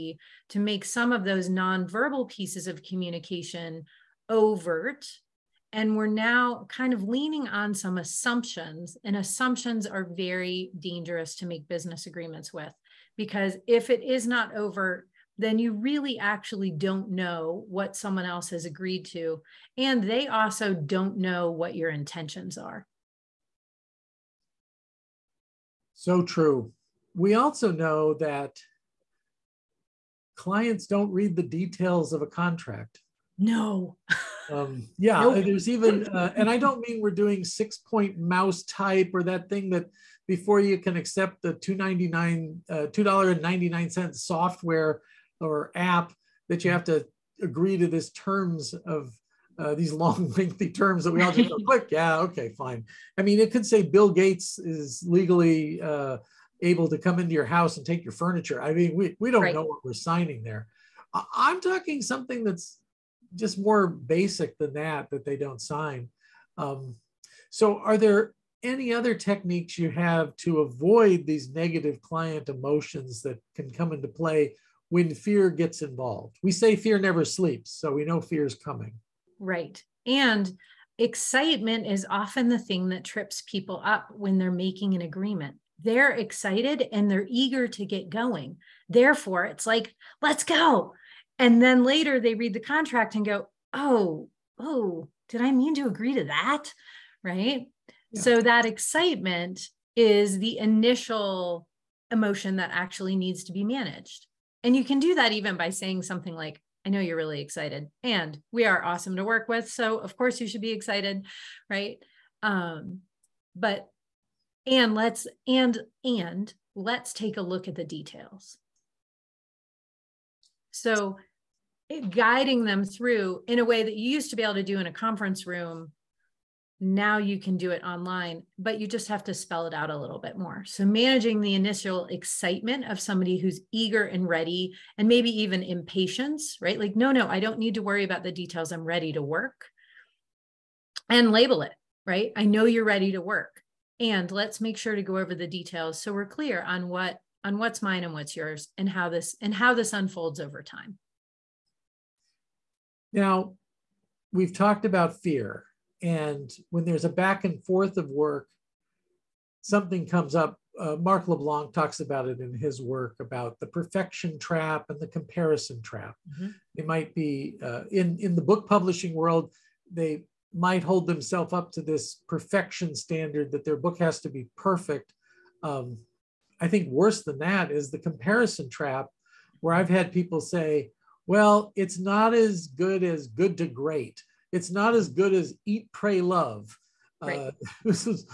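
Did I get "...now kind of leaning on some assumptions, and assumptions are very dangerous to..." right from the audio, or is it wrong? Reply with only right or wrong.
right.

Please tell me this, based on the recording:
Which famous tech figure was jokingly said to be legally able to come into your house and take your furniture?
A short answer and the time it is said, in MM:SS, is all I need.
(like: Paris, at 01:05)
Bill Gates, at 00:53.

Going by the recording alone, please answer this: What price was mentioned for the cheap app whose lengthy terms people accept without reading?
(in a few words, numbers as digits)
$2.99.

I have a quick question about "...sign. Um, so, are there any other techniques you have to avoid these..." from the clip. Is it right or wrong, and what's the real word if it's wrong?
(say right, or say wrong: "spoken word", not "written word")
right.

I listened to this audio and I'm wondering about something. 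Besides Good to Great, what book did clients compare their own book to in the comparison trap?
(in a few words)
Eat, Pray, Love.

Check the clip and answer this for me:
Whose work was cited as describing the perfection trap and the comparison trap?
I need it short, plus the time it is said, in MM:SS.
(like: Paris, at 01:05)
Mark LeBlanc, at 02:40.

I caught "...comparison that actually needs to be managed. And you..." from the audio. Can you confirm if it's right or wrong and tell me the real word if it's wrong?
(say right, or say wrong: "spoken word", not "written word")
wrong: "emotion", not "comparison".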